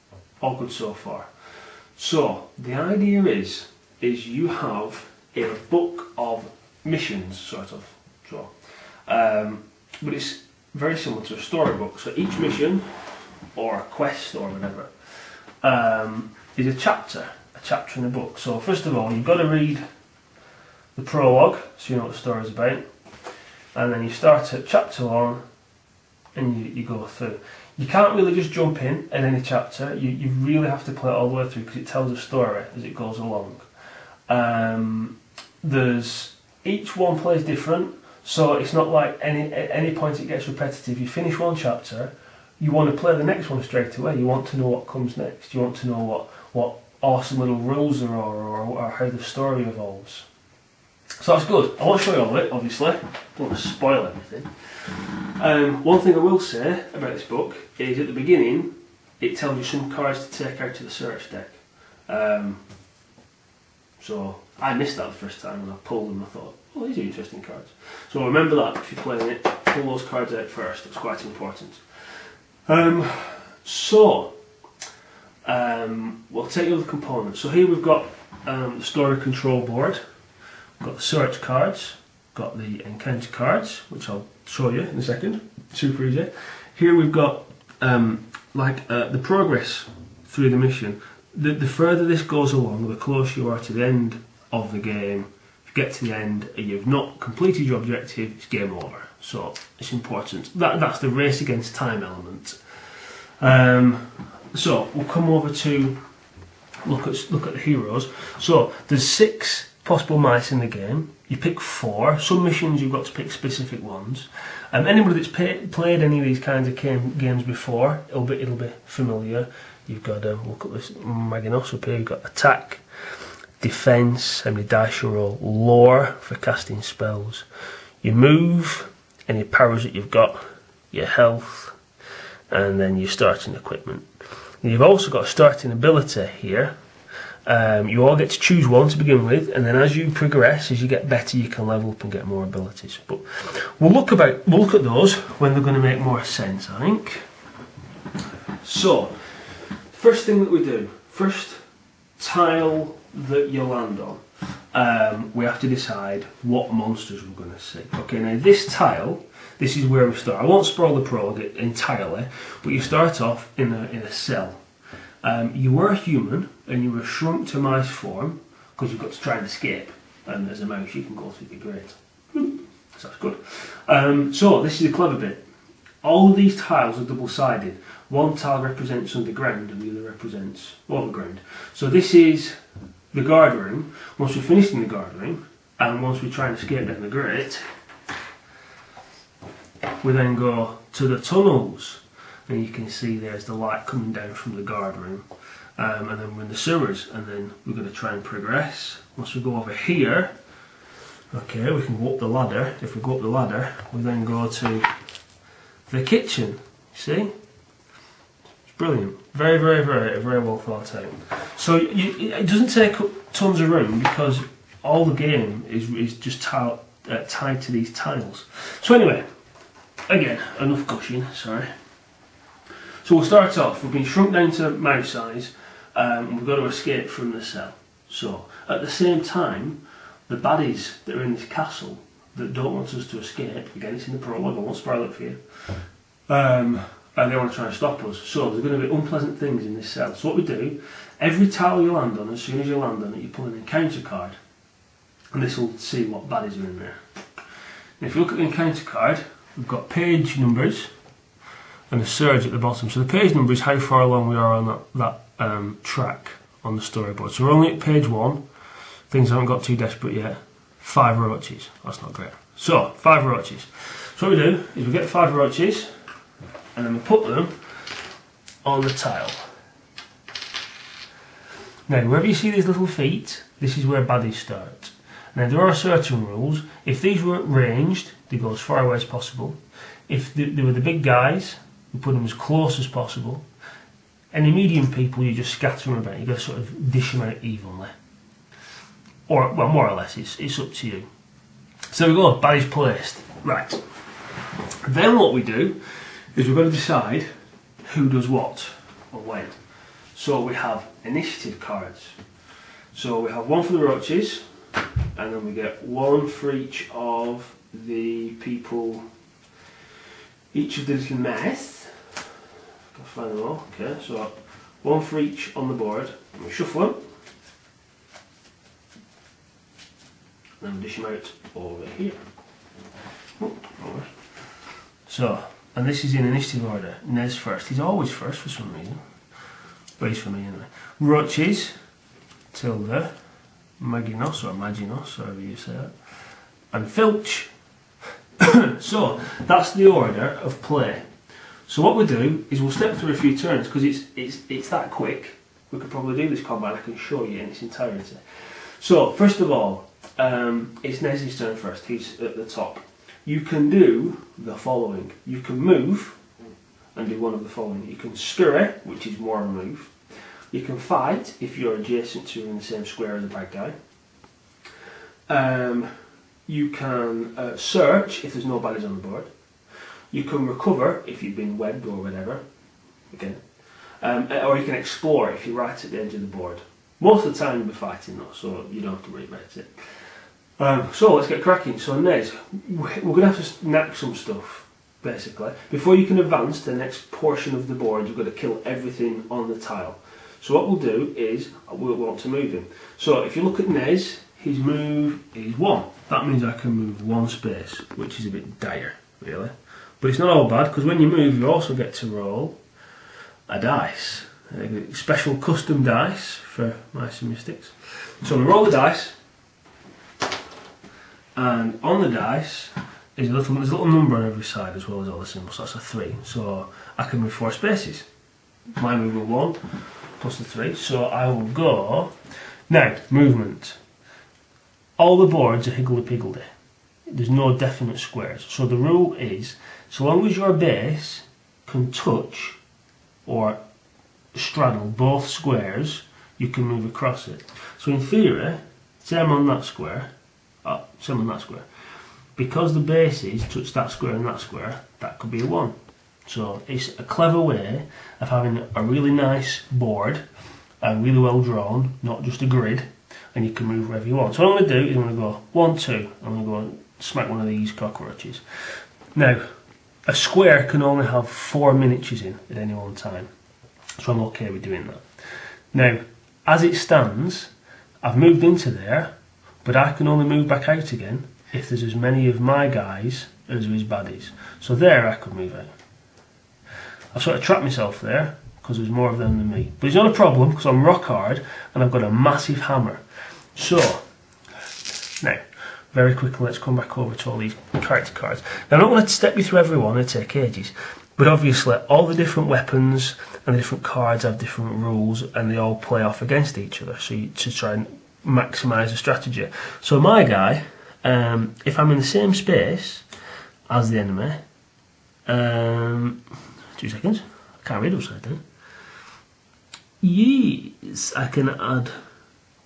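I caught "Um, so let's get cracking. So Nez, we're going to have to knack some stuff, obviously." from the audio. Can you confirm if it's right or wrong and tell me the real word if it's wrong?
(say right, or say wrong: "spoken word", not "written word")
wrong: "basically", not "obviously".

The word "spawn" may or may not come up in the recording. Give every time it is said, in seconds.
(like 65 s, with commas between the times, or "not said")
not said.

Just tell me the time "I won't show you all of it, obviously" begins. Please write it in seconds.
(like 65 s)
51 s.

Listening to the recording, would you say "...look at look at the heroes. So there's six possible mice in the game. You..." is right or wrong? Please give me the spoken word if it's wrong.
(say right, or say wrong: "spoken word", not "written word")
right.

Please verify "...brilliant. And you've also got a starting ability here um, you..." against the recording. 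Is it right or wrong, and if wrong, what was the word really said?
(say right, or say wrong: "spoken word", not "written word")
wrong: "equipment", not "brilliant".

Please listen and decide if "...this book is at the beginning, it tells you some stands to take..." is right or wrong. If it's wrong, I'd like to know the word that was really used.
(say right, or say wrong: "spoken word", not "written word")
wrong: "cards", not "stands".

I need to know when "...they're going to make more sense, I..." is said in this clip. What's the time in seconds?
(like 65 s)
145 s.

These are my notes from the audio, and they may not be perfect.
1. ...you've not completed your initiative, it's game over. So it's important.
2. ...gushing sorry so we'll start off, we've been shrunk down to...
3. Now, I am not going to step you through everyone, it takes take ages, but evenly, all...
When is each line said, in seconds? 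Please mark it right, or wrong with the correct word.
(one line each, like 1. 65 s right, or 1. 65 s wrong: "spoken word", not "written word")
1. 96 s wrong: "objective", not "initiative"
2. 220 s right
3. 488 s wrong: "obviously", not "evenly".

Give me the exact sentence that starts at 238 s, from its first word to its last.
So there's going to be unpleasant things in this cell.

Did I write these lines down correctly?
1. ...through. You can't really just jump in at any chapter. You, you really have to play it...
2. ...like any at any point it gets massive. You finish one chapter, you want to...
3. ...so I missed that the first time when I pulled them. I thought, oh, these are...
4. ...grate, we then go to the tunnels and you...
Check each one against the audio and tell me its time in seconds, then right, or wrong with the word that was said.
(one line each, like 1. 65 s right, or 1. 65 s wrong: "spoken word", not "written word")
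1. 27 s right
2. 38 s wrong: "repetitive", not "massive"
3. 64 s right
4. 187 s right.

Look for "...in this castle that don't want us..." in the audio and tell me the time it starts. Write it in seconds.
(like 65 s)
231 s.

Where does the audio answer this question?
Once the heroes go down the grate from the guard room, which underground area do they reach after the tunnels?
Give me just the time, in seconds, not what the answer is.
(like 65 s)
196 s.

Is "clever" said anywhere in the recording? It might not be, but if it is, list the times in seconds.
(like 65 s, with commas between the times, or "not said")
174 s, 447 s.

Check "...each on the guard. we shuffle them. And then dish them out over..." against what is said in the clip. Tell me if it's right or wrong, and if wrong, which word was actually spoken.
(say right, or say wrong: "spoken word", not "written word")
wrong: "board", not "guard".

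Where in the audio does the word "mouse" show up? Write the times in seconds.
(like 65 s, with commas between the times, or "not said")
170 s, 224 s.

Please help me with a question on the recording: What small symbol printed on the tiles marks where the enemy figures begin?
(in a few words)
little feet.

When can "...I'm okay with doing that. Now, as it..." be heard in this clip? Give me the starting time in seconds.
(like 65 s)
464 s.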